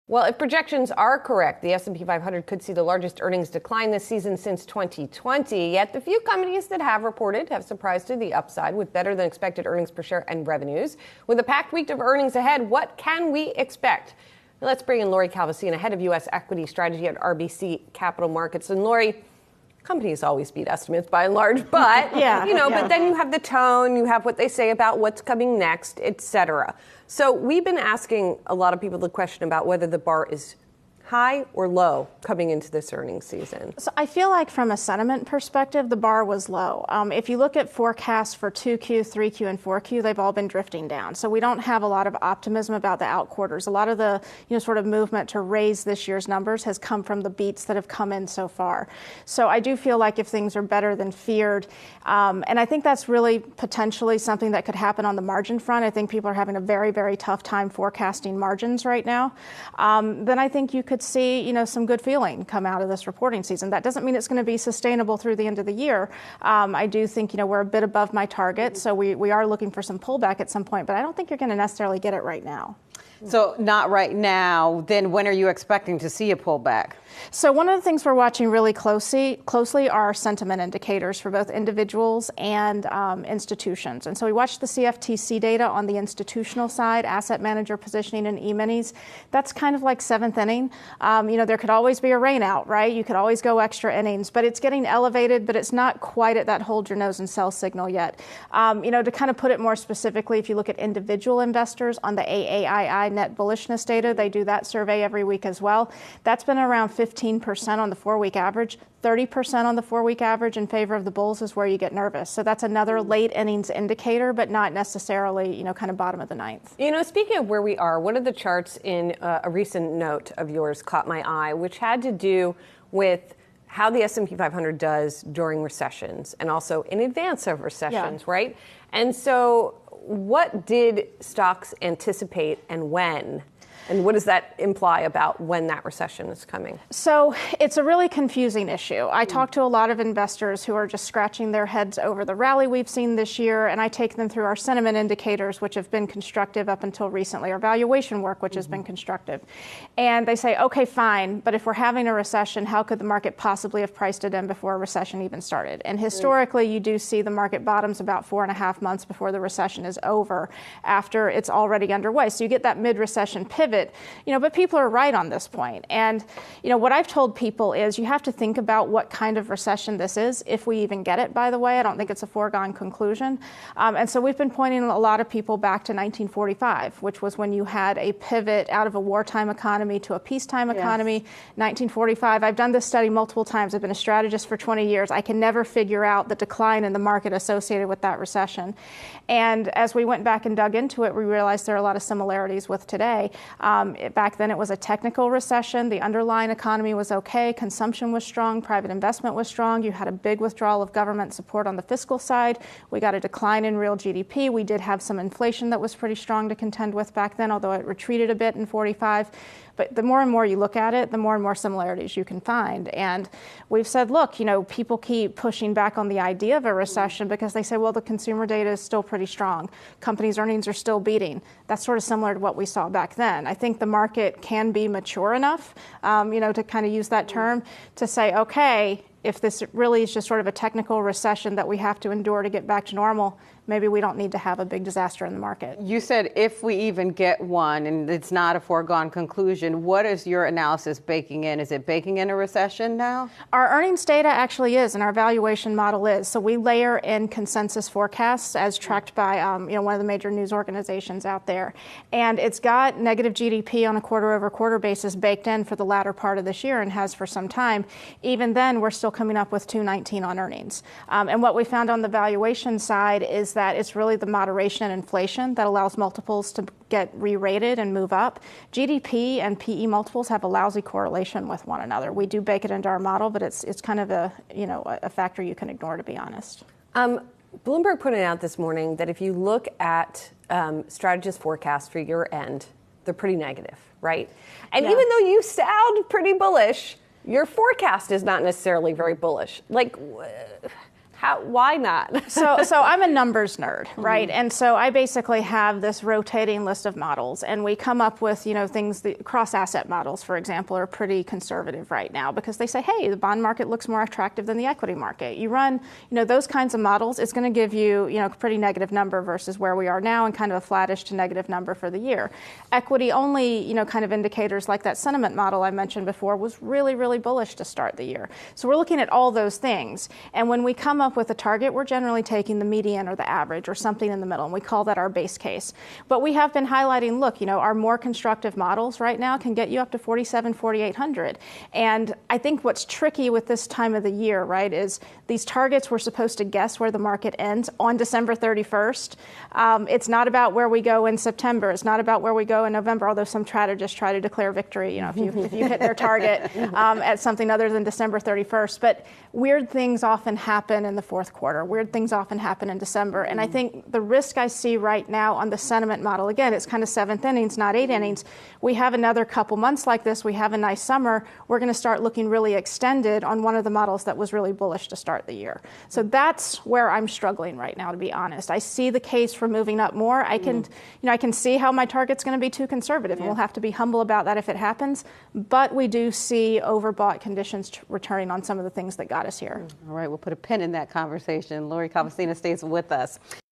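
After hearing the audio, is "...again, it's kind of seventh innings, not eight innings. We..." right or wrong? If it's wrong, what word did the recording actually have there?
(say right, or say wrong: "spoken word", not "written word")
right.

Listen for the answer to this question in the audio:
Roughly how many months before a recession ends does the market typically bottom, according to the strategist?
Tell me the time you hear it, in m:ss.
2:38.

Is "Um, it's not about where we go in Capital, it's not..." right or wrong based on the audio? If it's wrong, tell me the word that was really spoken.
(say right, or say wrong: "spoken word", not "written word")
wrong: "September", not "Capital".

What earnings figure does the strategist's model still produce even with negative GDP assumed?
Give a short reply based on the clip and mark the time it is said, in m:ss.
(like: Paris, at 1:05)
219, at 4:19.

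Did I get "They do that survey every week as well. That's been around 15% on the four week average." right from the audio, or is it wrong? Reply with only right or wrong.
right.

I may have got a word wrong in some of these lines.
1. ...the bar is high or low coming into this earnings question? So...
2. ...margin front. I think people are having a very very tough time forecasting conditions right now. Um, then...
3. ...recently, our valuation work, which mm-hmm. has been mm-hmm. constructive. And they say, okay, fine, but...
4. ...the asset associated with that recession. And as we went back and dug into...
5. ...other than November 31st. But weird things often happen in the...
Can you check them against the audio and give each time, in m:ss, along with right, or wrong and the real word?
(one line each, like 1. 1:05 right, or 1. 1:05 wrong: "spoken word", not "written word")
1. 0:29 wrong: "season", not "question"
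2. 0:55 wrong: "margins", not "conditions"
3. 2:27 right
4. 3:06 wrong: "market", not "asset"
5. 5:47 wrong: "December", not "November".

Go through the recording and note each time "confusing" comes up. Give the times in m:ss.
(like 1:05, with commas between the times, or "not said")
2:18.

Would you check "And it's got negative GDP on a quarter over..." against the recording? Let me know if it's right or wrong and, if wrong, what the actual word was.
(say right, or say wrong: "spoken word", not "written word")
right.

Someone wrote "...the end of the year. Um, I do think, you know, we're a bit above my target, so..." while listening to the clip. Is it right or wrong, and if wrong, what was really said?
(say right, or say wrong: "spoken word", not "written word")
right.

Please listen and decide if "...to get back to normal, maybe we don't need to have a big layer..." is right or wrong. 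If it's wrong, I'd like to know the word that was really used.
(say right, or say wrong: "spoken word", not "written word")
wrong: "disaster", not "layer".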